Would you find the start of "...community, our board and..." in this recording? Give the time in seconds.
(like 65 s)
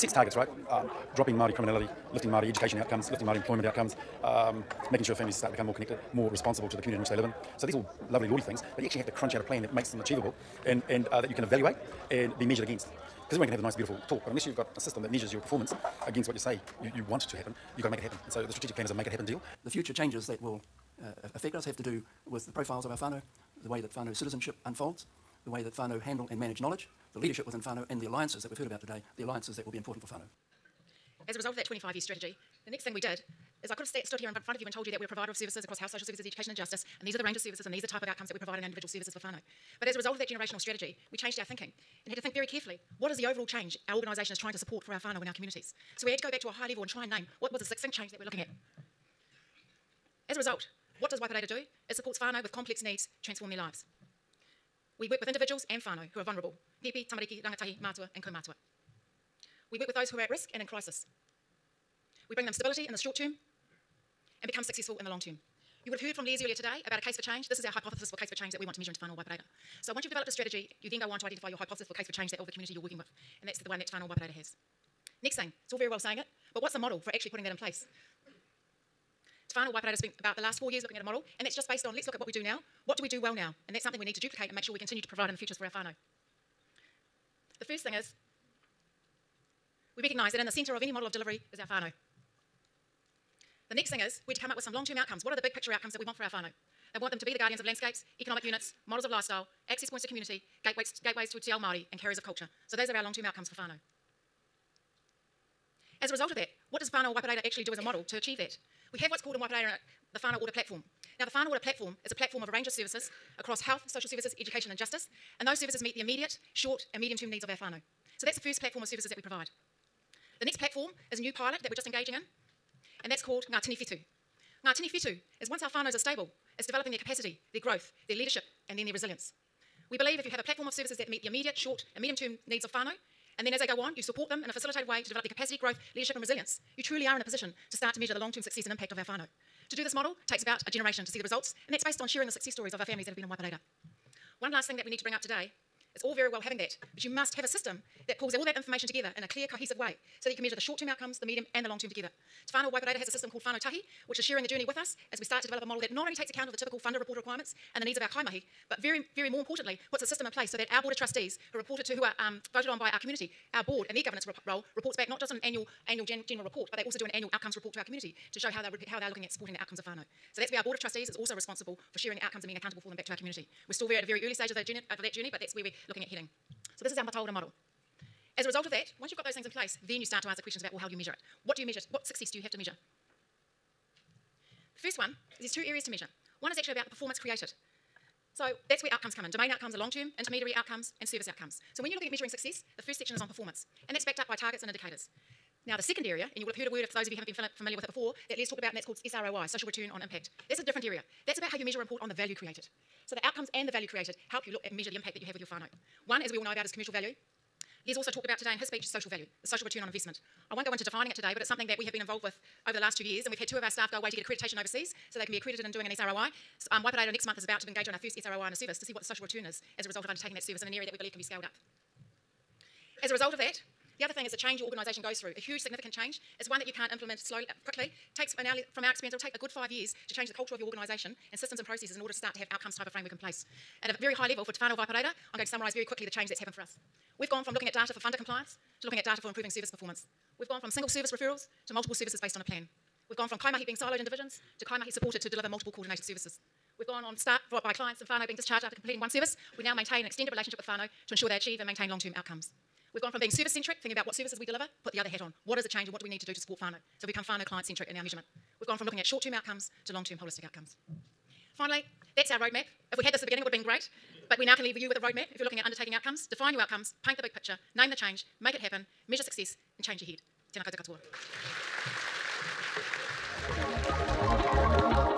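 162 s.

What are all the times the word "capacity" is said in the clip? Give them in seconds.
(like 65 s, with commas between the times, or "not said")
126 s, 135 s.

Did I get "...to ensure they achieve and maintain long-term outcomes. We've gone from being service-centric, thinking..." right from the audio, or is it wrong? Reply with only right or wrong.
right.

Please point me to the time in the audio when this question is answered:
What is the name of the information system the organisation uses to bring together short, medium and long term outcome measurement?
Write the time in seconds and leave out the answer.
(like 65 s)
153 s.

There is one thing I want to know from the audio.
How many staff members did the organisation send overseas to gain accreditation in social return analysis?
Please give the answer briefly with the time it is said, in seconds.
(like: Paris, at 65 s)
2, at 213 s.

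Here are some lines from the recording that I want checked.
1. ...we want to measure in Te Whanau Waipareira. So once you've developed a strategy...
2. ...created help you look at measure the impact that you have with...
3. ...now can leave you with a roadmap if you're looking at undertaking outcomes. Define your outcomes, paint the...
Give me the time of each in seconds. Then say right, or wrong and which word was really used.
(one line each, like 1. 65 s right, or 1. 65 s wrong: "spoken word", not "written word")
1. 68 s right
2. 203 s right
3. 264 s right.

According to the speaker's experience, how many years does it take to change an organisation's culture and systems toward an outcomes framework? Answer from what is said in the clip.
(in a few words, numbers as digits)
5 years.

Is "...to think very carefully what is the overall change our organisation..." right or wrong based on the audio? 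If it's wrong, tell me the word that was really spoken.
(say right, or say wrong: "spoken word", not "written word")
right.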